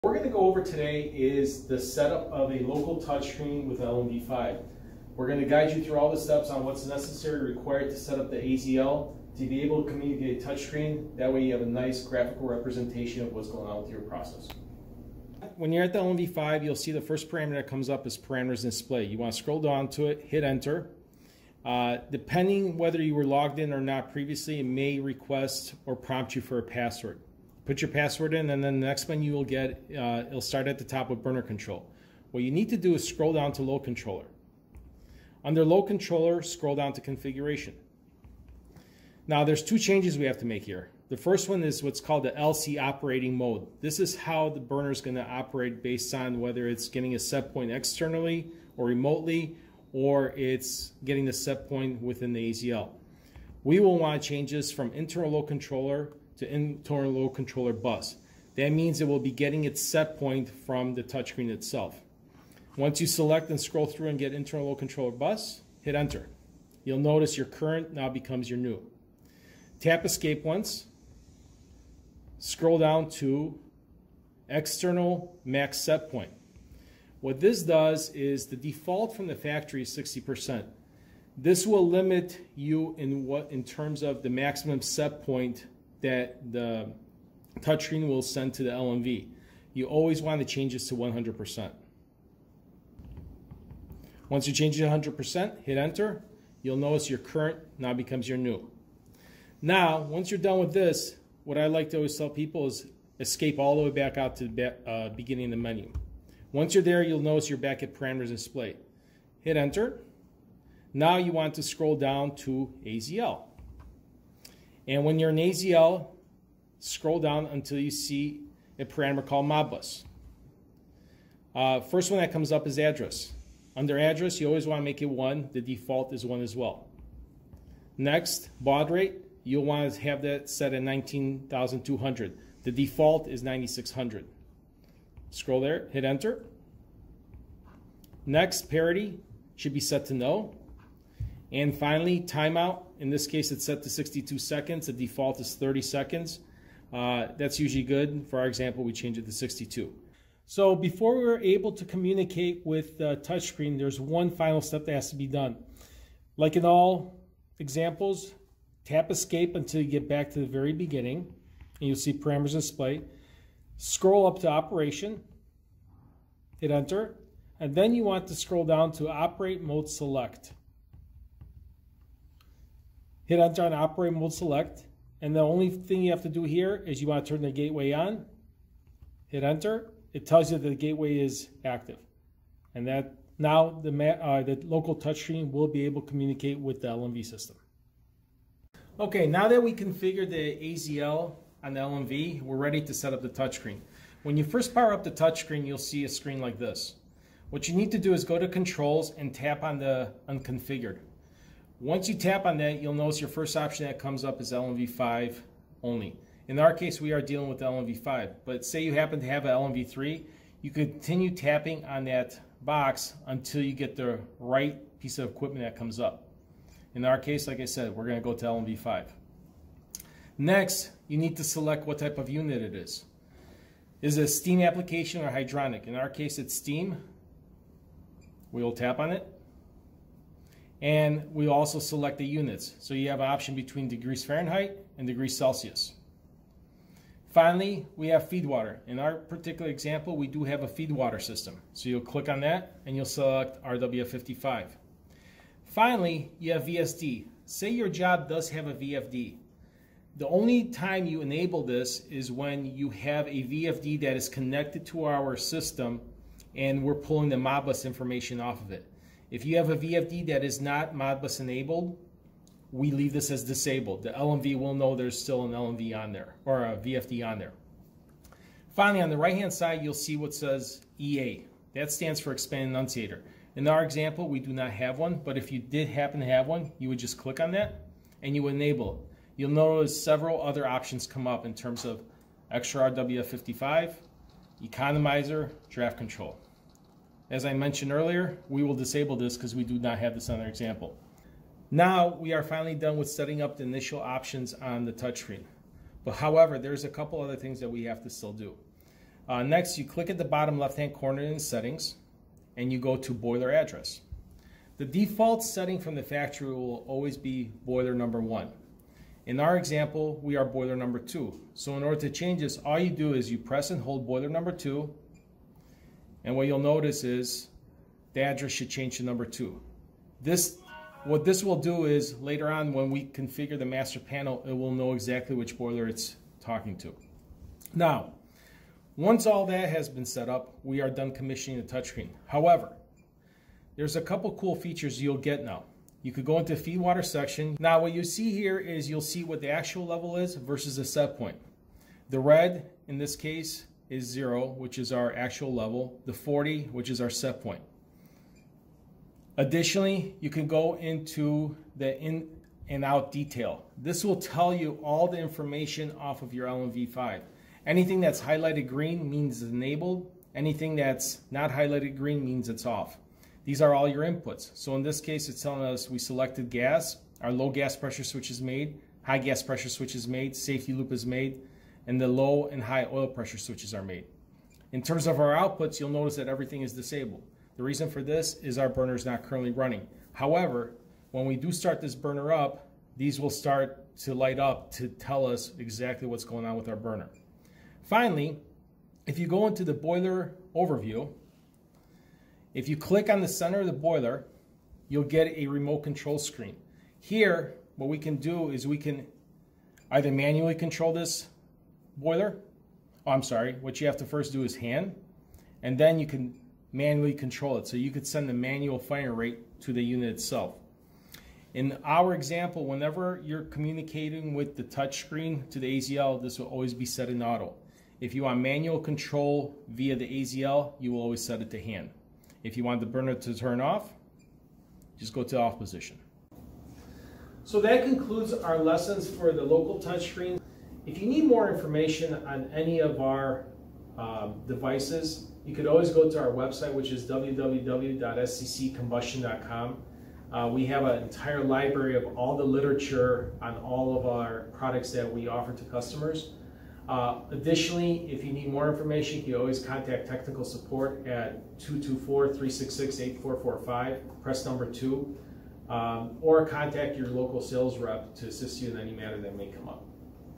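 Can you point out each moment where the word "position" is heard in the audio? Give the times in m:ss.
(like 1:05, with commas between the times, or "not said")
7:05.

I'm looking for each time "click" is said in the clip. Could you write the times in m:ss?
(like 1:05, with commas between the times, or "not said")
4:02, 4:37, 4:59, 6:32.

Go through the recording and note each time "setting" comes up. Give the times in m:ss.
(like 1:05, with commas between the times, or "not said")
4:53, 5:01, 5:05.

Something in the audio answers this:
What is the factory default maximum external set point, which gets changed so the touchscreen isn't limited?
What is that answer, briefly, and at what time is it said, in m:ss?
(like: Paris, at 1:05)
60%, at 1:19.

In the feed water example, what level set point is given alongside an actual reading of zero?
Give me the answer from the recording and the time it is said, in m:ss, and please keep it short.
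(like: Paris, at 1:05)
40, at 5:46.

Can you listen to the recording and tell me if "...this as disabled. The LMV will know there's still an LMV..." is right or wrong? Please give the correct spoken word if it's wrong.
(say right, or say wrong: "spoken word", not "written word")
right.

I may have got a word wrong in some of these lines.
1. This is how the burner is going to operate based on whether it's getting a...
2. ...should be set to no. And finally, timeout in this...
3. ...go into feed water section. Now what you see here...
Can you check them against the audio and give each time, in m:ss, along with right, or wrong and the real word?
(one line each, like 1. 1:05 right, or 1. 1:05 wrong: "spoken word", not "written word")
1. 0:43 right
2. 2:19 right
3. 5:36 right.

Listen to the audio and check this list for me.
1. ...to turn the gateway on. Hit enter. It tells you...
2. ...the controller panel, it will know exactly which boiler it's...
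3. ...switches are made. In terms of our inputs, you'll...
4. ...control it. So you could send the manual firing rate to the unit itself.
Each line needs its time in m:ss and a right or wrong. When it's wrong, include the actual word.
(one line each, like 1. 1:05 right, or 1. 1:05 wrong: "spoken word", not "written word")
1. 2:57 right
2. 5:23 wrong: "master", not "controller"
3. 6:13 wrong: "outputs", not "inputs"
4. 6:47 right.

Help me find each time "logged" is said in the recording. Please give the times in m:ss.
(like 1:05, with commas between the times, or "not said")
0:23.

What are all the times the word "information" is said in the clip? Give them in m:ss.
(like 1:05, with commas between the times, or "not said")
4:17, 5:55, 7:11, 7:28.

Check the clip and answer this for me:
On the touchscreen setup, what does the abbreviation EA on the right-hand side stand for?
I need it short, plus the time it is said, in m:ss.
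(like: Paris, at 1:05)
Expand Annunciator, at 4:32.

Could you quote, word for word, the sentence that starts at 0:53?
We will want to change this from internal load controller to internal load controller bus.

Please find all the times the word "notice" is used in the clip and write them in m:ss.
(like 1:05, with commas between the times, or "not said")
1:06, 1:36, 1:47, 3:22, 4:39, 5:16, 6:15.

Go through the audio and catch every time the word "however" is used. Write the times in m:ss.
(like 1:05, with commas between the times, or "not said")
4:56, 5:32, 6:20.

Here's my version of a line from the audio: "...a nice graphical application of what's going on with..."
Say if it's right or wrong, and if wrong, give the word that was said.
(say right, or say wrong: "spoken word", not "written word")
wrong: "representation", not "application".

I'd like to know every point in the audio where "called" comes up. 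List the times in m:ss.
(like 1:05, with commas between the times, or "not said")
0:41, 1:59.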